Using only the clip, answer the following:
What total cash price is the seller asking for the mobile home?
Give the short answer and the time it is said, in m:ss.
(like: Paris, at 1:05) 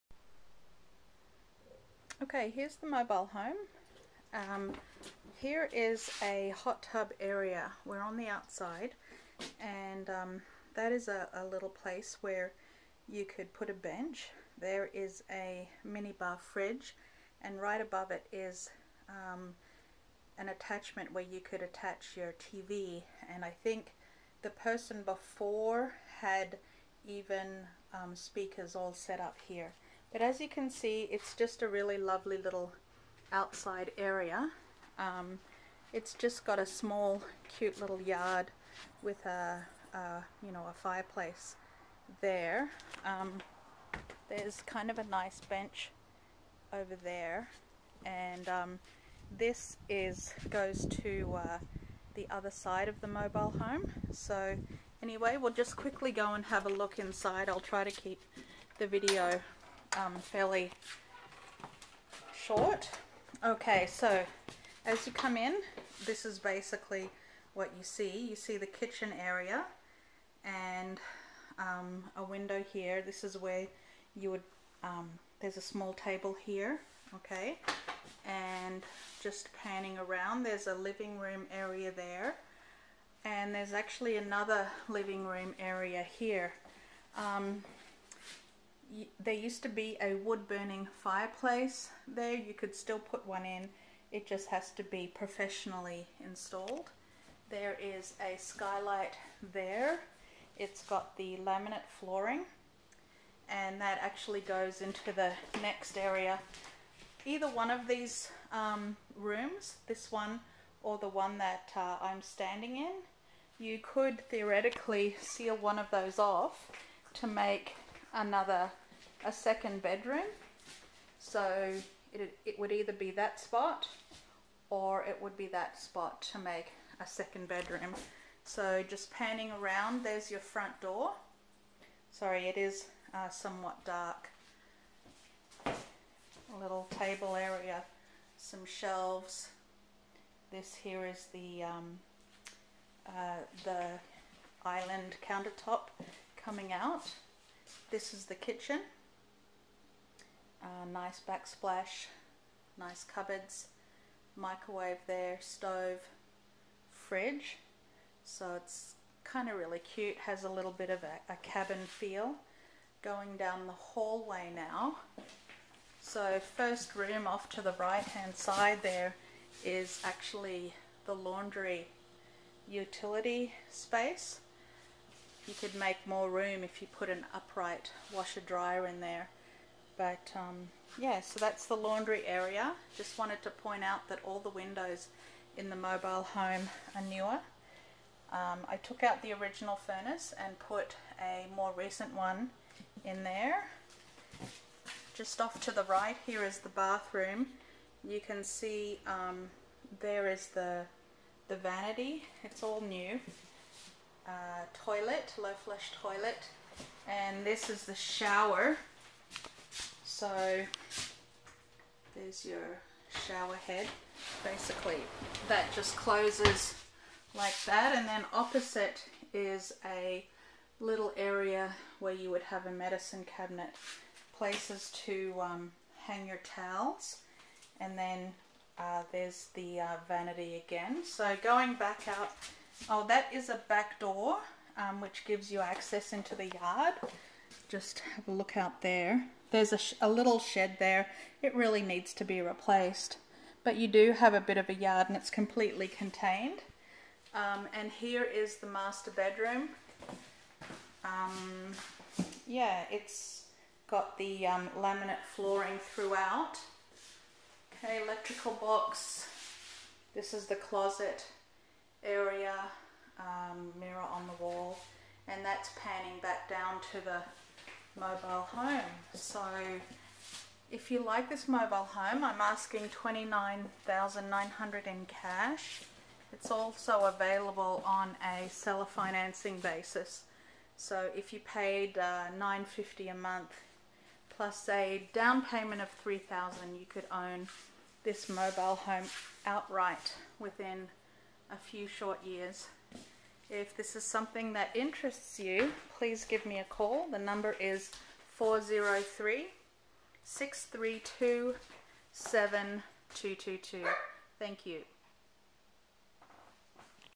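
29900, at 4:32.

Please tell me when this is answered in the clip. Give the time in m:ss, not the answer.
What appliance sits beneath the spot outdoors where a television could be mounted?
0:15.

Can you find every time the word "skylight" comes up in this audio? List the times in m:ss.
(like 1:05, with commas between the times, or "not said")
1:38.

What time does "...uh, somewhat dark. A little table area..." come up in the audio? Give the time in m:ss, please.
2:13.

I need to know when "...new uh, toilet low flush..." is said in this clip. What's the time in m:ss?
3:22.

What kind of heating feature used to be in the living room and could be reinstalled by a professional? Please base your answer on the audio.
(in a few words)
Wood burning fireplace.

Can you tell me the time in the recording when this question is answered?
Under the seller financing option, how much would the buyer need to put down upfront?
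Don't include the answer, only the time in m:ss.
4:46.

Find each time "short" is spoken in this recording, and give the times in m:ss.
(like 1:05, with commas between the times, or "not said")
1:02, 4:51.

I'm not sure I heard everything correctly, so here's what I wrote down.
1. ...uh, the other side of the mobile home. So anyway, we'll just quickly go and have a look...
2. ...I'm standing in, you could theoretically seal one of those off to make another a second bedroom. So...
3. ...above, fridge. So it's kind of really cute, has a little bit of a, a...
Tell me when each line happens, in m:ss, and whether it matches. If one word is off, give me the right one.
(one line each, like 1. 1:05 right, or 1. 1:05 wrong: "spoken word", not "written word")
1. 0:51 right
2. 1:52 right
3. 2:35 wrong: "stove", not "above".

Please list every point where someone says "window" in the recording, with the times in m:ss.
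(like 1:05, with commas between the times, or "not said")
1:12, 3:04.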